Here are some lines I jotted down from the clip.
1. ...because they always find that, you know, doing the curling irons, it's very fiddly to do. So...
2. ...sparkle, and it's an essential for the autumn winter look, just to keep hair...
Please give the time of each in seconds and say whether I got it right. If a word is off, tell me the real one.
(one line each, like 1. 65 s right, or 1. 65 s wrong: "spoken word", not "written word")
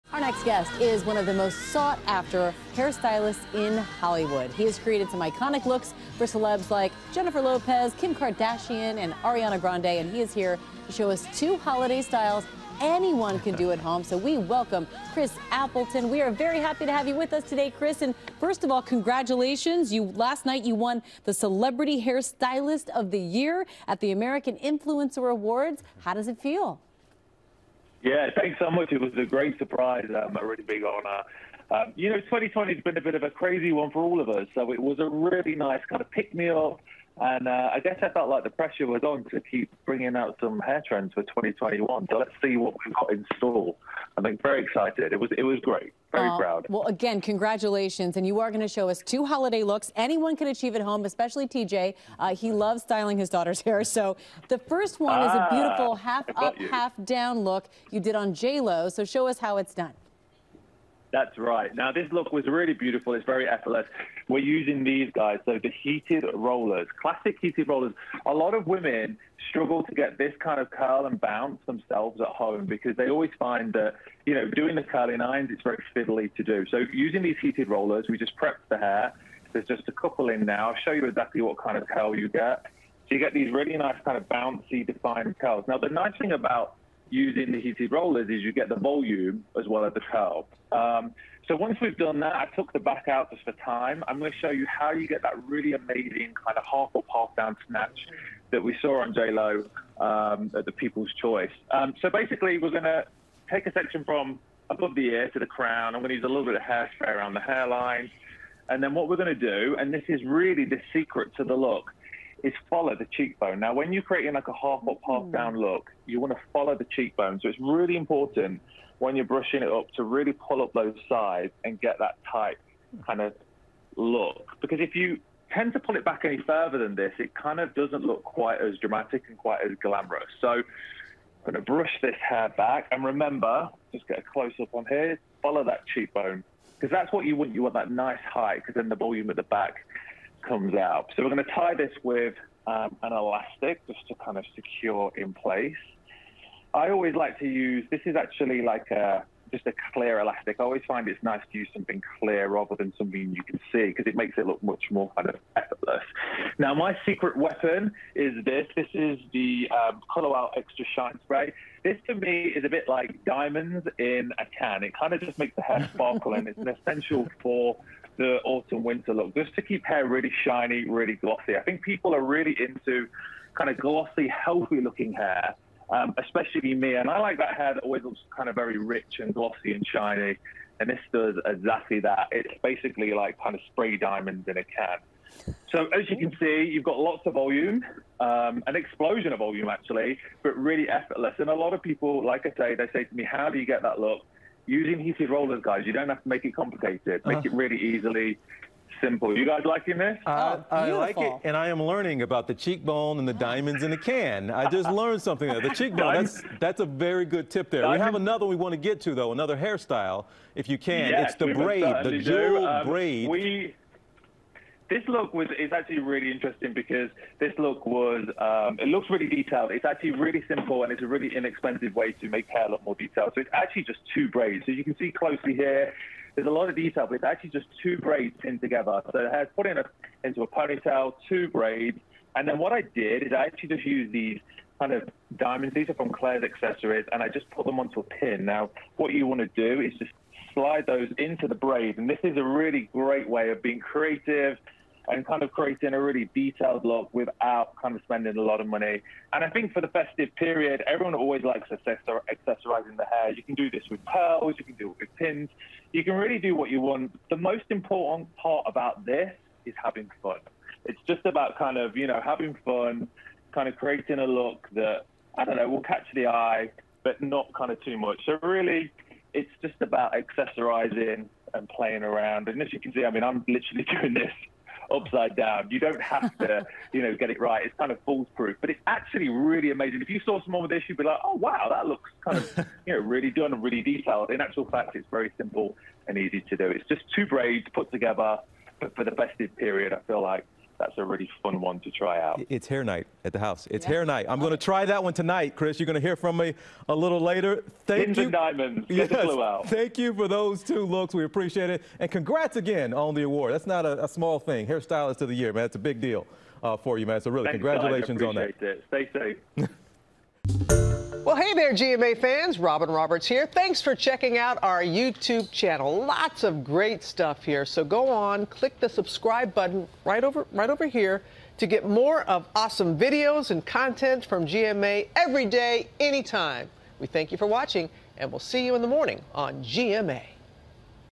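1. 72 s right
2. 165 s right.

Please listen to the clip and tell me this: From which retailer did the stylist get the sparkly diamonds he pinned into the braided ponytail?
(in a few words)
Claire's accessories.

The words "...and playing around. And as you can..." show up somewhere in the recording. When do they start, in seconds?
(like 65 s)
271 s.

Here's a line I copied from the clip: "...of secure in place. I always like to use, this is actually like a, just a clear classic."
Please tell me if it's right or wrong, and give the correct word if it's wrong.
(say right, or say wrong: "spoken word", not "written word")
wrong: "elastic", not "classic".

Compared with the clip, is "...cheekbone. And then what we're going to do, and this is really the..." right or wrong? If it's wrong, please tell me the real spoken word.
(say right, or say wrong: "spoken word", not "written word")
wrong: "hairline", not "cheekbone".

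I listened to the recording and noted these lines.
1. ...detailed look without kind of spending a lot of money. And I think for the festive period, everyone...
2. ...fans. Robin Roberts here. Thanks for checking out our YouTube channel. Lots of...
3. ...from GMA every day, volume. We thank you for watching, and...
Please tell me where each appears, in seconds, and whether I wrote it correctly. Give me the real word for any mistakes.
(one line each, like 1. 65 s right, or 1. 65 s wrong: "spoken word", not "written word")
1. 246 s right
2. 312 s right
3. 324 s wrong: "anytime", not "volume".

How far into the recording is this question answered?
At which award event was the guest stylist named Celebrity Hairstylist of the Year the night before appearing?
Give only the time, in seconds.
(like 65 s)
24 s.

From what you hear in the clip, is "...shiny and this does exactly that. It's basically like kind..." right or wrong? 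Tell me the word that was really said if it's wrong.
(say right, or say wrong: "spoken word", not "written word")
right.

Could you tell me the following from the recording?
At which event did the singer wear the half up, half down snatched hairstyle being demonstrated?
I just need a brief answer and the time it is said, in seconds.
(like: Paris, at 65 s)
People's Choice, at 100 s.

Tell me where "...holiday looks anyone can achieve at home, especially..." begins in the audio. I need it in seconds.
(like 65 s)
49 s.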